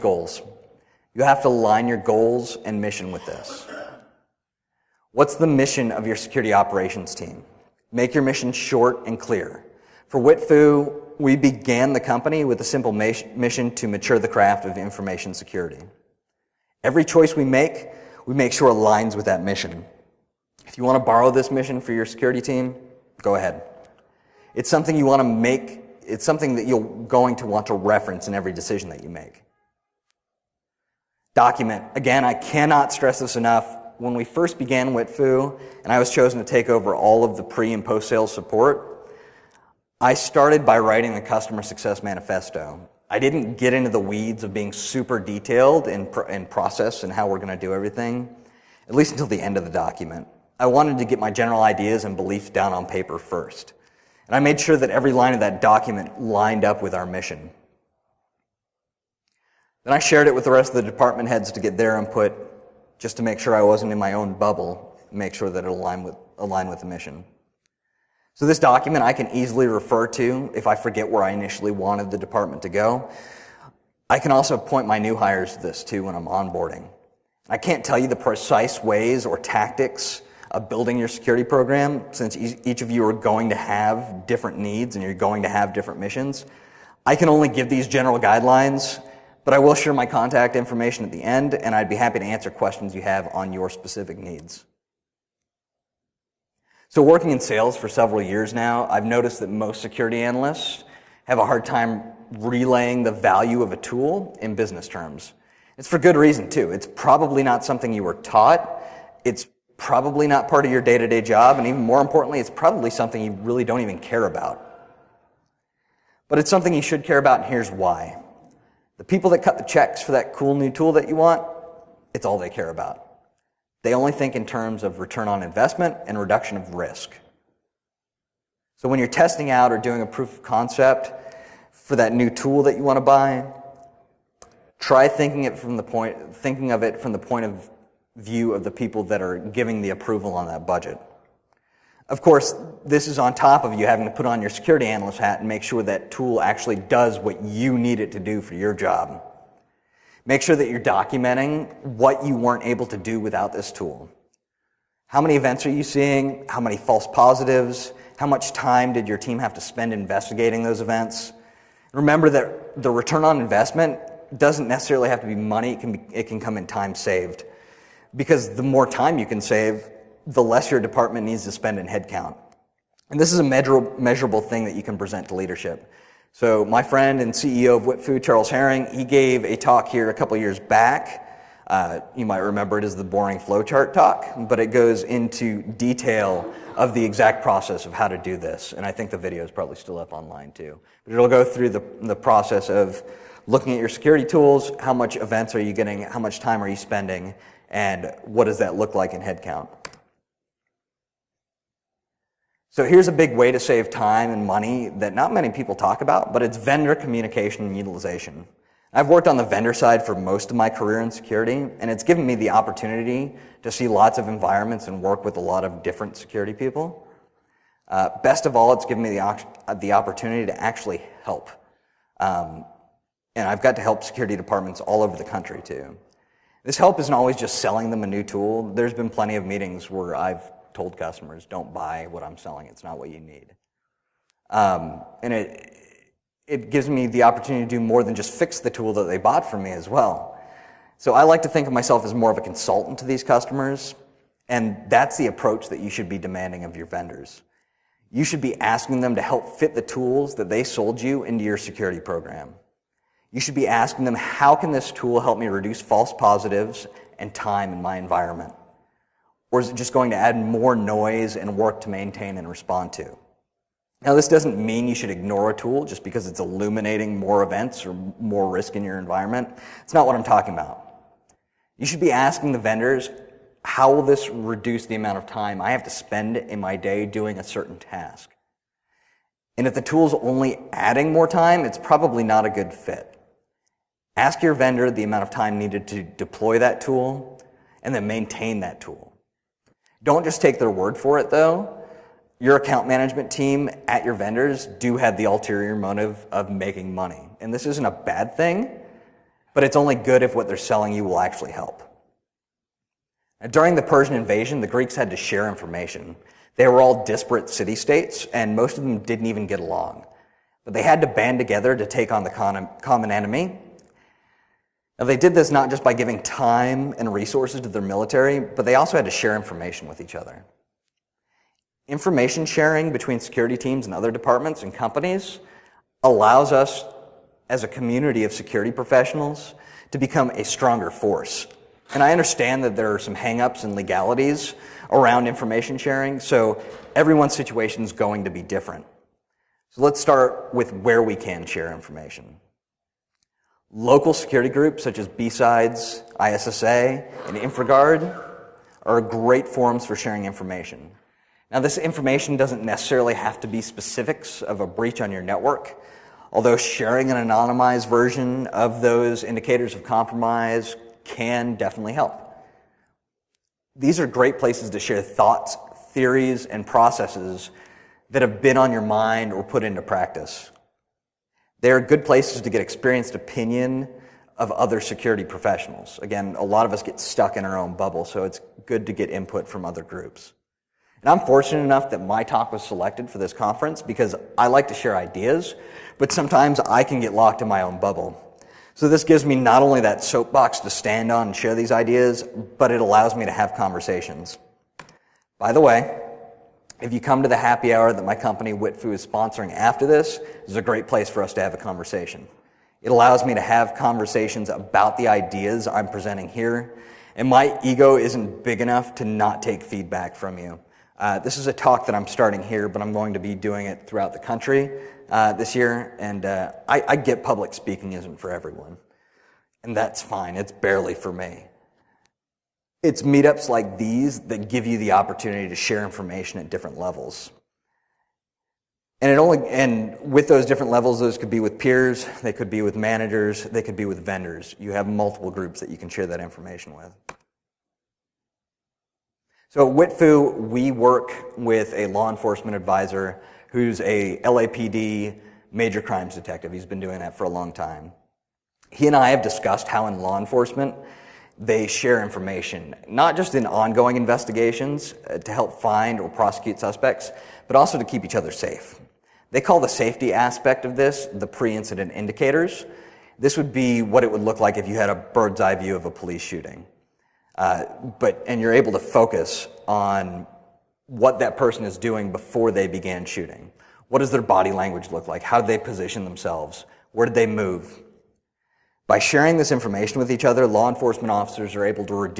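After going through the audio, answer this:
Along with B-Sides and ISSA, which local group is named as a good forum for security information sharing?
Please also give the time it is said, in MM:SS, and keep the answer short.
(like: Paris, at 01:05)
InfraGard, at 05:47.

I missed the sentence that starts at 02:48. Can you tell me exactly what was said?
Because the more time you can save, the less your department needs to spend in headcount.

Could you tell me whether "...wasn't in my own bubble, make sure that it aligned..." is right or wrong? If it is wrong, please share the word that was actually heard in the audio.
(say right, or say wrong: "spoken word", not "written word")
right.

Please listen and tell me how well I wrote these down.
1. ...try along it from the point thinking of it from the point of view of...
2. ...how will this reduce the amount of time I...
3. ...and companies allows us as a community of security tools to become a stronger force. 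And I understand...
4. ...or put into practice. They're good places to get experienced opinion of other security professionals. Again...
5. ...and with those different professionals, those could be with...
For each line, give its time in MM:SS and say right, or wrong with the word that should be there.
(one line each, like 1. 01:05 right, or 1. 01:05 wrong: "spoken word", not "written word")
1. 02:14 wrong: "thinking", not "along"
2. 04:33 right
3. 05:24 wrong: "professionals", not "tools"
4. 06:09 right
5. 07:09 wrong: "levels", not "professionals".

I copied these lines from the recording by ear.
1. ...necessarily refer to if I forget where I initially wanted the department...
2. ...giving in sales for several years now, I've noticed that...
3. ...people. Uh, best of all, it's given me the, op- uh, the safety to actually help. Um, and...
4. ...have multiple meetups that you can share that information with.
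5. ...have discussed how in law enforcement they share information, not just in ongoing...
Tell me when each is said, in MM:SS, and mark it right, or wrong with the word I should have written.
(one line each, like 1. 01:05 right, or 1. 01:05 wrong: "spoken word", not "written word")
1. 01:09 wrong: "easily", not "necessarily"
2. 01:37 wrong: "working", not "giving"
3. 03:36 wrong: "opportunity", not "safety"
4. 07:14 wrong: "groups", not "meetups"
5. 07:29 right.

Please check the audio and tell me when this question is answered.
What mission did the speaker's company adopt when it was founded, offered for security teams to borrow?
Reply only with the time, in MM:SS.
00:13.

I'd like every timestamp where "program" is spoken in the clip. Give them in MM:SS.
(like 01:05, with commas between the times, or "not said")
01:21, 04:11.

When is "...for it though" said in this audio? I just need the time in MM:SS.
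04:50.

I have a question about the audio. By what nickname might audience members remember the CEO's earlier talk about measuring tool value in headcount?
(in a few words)
The boring flowchart talk.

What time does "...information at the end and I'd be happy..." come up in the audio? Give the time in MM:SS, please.
01:30.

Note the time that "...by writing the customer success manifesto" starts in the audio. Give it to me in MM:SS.
00:40.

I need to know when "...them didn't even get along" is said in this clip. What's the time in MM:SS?
05:08.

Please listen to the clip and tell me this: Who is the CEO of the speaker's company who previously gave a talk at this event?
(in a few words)
Charles Herring.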